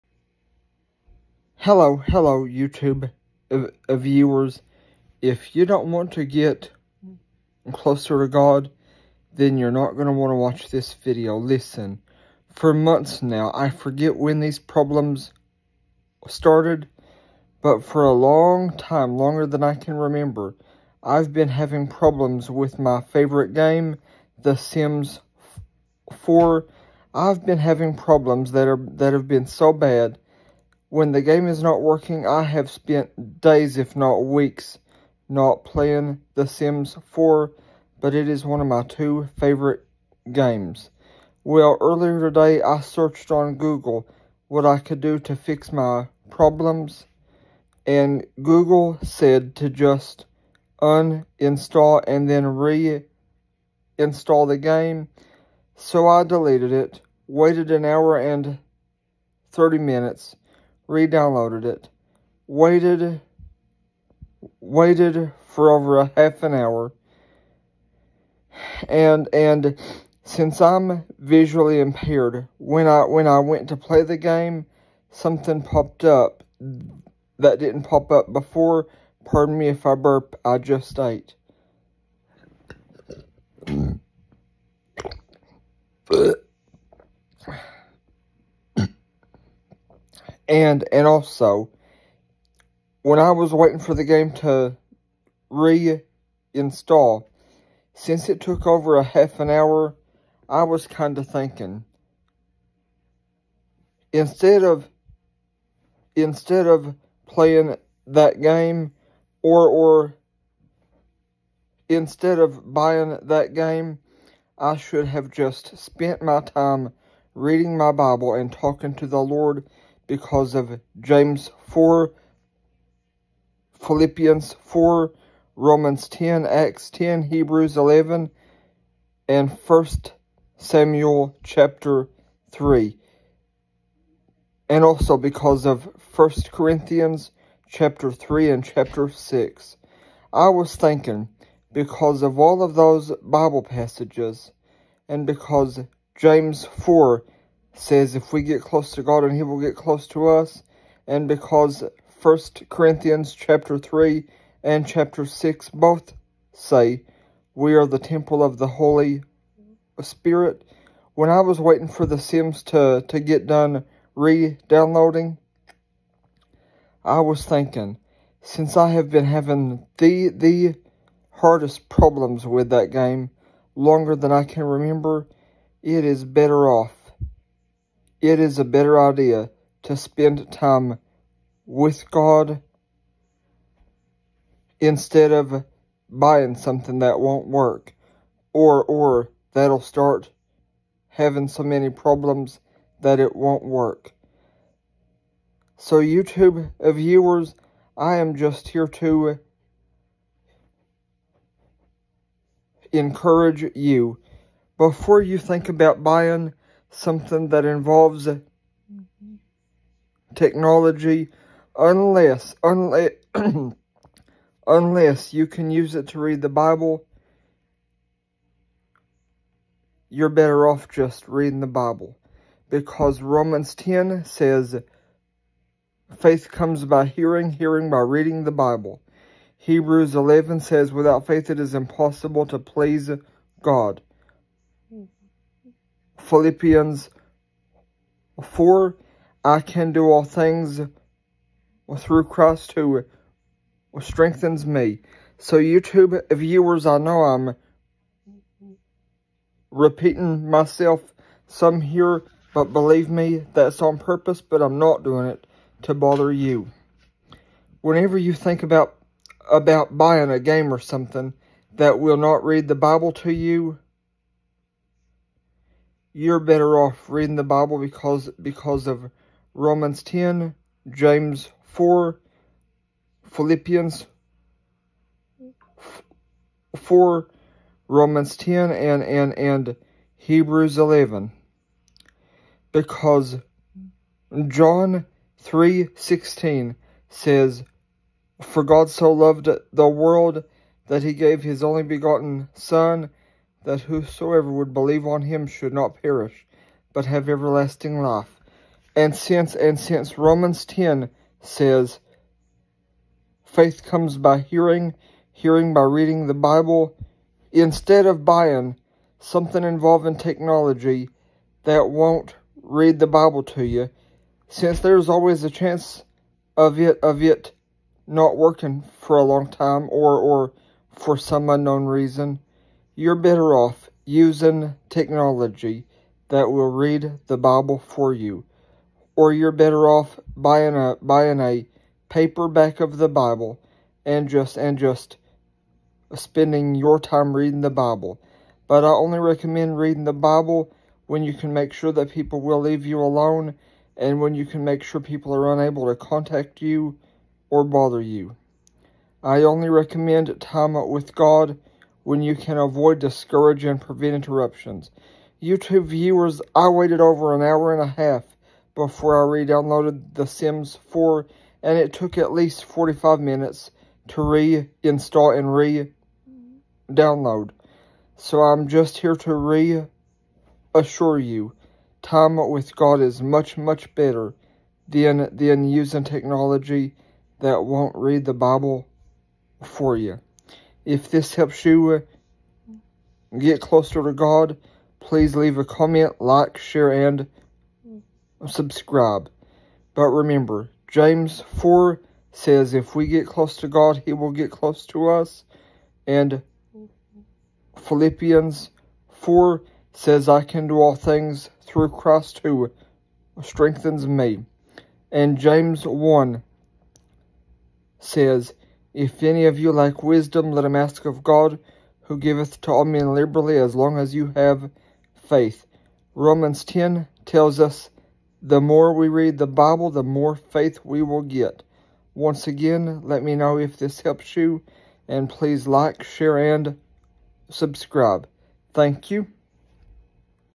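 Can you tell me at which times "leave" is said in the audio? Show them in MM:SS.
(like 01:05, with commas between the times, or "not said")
05:42, 06:25.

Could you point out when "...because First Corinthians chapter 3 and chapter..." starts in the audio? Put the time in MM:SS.
02:31.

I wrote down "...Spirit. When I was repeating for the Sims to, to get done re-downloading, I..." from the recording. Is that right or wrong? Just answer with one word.
wrong.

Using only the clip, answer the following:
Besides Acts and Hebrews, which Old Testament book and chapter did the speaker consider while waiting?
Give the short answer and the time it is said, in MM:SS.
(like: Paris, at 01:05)
1 Samuel 3, at 02:09.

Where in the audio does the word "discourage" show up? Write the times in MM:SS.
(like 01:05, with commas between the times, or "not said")
05:52.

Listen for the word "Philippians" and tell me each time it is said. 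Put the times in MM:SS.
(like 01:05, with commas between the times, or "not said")
02:03, 03:56, 04:33, 06:37.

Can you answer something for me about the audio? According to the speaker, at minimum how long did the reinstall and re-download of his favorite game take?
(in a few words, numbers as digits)
45 minutes.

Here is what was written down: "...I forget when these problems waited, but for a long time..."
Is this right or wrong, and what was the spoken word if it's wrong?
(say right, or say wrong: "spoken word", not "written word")
wrong: "started", not "waited".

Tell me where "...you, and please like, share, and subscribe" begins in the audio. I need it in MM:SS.
07:04.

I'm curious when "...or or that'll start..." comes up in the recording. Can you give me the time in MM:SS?
03:08.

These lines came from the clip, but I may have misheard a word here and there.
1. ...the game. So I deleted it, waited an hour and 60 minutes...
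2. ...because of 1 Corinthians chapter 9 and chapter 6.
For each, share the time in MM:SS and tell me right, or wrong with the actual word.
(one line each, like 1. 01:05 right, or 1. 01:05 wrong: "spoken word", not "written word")
1. 00:54 wrong: "30", not "60"
2. 02:15 wrong: "3", not "9".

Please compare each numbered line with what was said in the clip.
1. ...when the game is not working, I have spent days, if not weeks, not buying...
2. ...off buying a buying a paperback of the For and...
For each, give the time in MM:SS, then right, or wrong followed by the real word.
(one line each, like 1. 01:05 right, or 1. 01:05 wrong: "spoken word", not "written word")
1. 00:30 wrong: "playing", not "buying"
2. 05:29 wrong: "Bible", not "For".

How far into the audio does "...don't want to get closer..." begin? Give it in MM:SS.
00:05.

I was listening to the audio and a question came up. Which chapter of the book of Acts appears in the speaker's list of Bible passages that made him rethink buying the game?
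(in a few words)
10.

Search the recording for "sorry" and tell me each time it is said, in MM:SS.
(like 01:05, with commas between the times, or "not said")
not said.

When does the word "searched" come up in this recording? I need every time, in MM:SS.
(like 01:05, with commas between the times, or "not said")
00:42.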